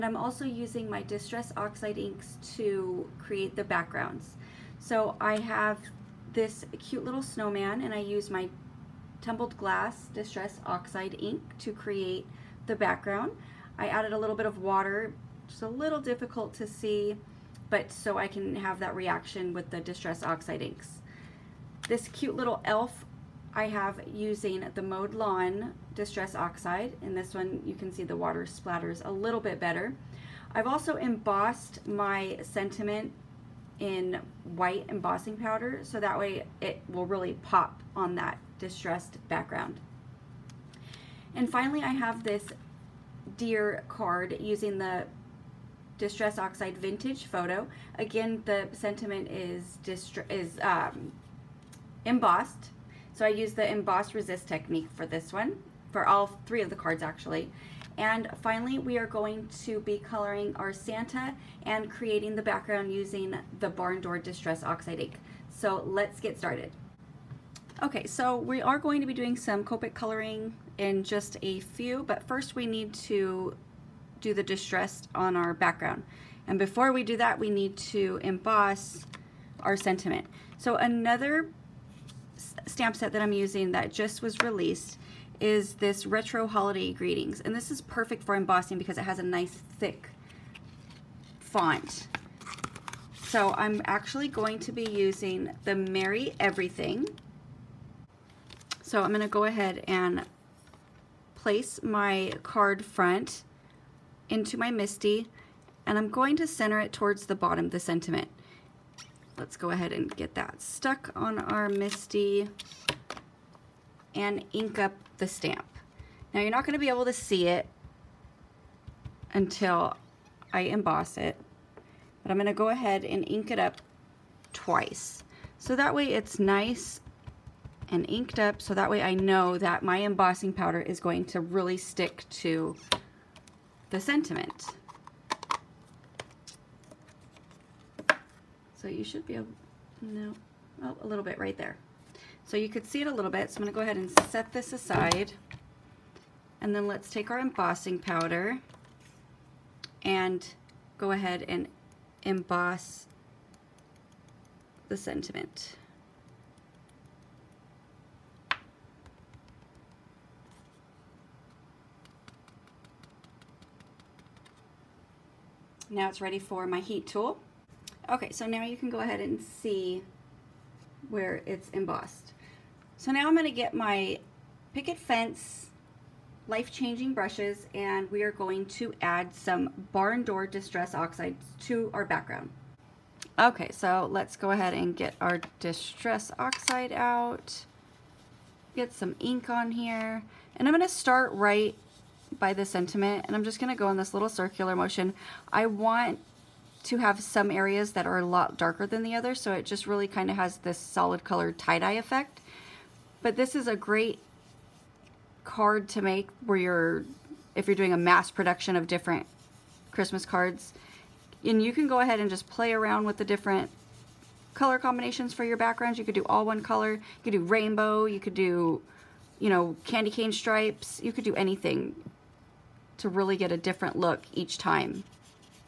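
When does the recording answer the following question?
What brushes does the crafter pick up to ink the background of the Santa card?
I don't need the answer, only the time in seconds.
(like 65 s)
174 s.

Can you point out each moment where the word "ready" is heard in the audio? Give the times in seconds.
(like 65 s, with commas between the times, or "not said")
166 s.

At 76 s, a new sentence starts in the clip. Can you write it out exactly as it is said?
And before we do that, we need to emboss our sentiment.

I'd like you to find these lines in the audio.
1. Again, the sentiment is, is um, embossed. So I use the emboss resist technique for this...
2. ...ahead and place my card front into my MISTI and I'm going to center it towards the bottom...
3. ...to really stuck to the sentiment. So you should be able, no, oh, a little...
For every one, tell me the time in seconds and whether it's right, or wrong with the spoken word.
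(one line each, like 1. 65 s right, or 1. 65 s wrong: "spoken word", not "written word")
1. 47 s right
2. 99 s right
3. 131 s wrong: "stick", not "stuck".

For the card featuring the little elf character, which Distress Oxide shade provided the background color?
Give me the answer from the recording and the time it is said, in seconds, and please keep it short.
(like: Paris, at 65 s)
Mowed Lawn, at 24 s.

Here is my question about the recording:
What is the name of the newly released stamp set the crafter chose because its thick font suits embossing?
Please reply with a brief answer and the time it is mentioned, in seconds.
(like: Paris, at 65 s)
Retro Holiday Greetings, at 86 s.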